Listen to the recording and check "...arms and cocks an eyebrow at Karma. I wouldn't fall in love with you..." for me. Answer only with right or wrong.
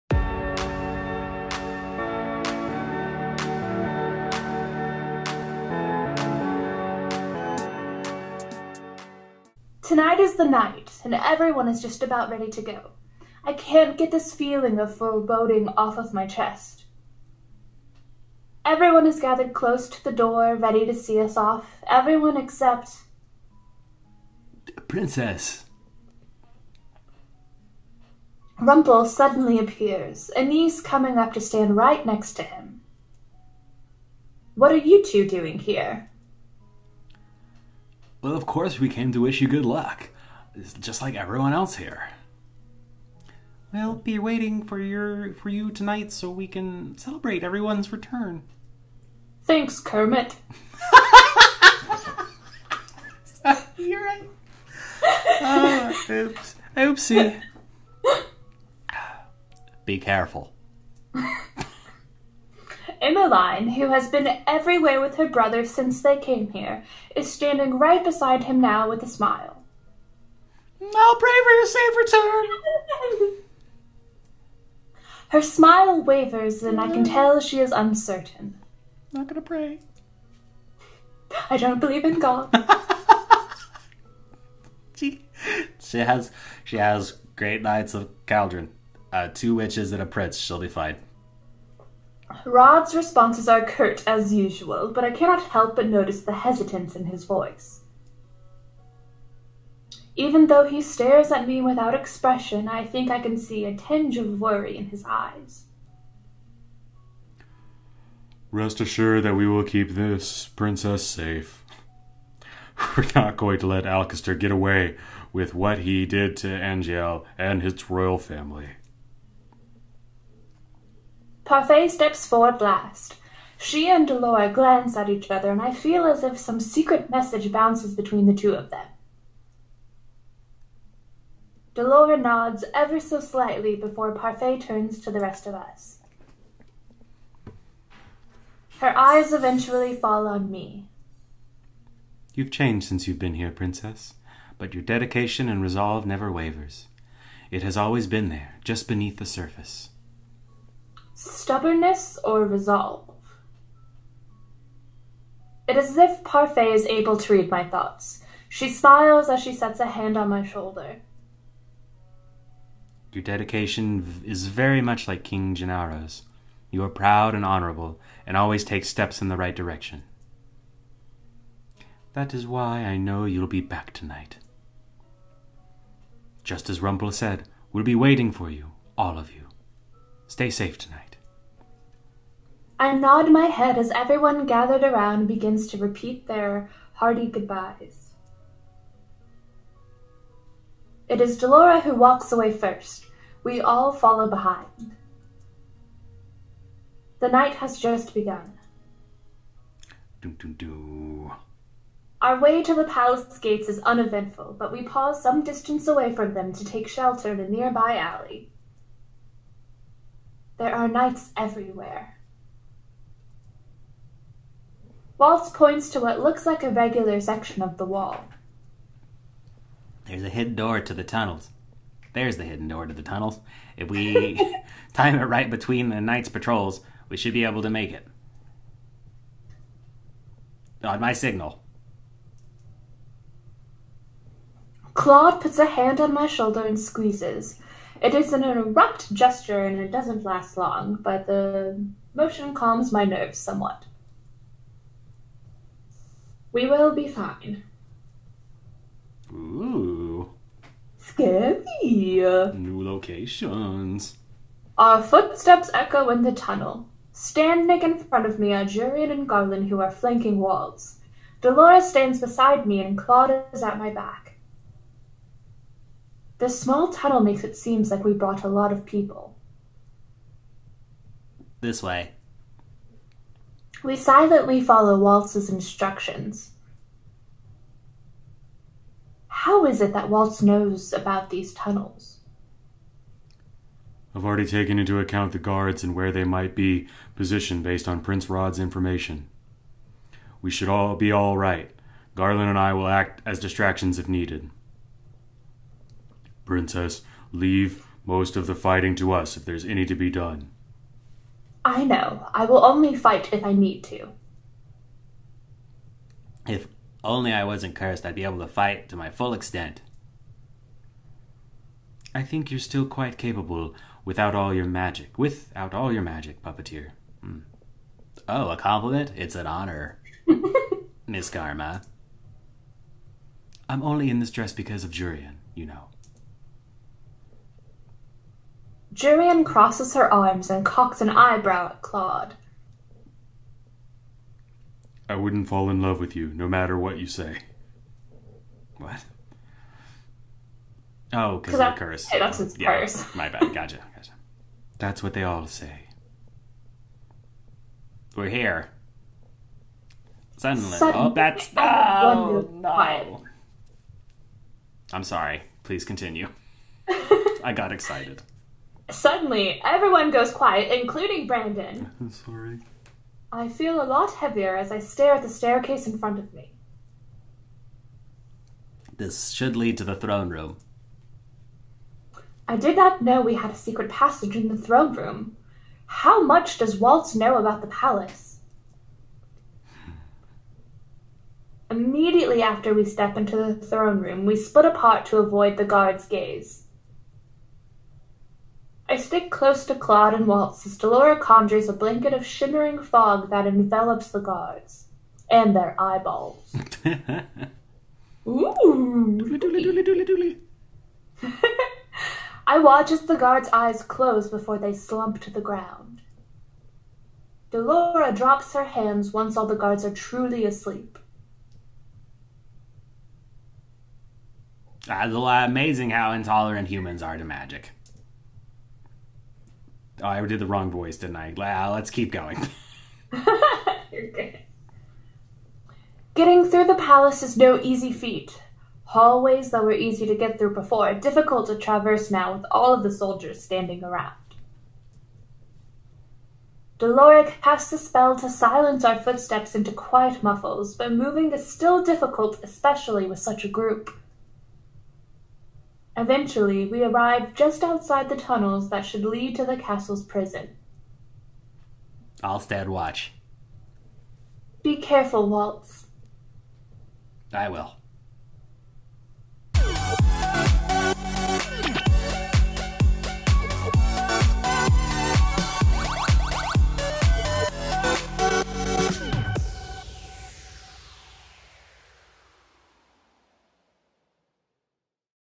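wrong.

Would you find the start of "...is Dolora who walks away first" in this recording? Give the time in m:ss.
3:11.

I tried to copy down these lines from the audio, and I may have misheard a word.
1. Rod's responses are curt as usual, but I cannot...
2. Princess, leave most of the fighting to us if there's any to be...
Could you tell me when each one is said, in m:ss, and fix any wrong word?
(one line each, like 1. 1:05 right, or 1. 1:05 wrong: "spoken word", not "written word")
1. 1:32 right
2. 4:56 right.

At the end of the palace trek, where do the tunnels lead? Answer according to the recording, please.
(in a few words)
The castle's prison.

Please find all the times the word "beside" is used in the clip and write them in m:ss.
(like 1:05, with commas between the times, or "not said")
1:08, 4:22.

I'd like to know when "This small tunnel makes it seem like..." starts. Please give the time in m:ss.
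4:26.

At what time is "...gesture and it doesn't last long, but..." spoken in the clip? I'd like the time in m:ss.
3:59.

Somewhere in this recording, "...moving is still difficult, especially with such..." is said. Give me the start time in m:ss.
7:20.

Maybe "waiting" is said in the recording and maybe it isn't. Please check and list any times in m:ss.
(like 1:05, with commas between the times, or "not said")
0:44, 2:57.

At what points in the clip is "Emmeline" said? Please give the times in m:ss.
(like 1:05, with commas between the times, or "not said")
1:03.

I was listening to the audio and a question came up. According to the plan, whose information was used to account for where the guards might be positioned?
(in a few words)
Prince Rod.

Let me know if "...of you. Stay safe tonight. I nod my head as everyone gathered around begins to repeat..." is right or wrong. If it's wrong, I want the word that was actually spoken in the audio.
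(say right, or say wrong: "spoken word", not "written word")
right.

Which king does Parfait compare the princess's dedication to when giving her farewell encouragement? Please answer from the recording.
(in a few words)
King Gennaro.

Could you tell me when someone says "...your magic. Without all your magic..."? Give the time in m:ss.
5:14.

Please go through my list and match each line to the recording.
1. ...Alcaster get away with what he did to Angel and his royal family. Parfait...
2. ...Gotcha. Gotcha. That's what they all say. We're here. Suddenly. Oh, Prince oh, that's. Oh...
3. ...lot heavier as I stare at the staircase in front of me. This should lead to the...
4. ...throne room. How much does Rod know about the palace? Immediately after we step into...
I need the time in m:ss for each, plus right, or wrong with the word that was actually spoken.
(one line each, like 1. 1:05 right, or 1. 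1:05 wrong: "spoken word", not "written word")
1. 1:53 right
2. 5:43 wrong: "Suddenly", not "Prince"
3. 6:03 right
4. 6:14 wrong: "Waltz", not "Rod".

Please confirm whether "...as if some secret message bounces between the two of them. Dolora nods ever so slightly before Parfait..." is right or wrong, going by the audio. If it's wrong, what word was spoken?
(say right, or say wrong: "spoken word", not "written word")
right.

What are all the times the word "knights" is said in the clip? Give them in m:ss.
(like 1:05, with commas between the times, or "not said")
1:27, 3:30, 3:45.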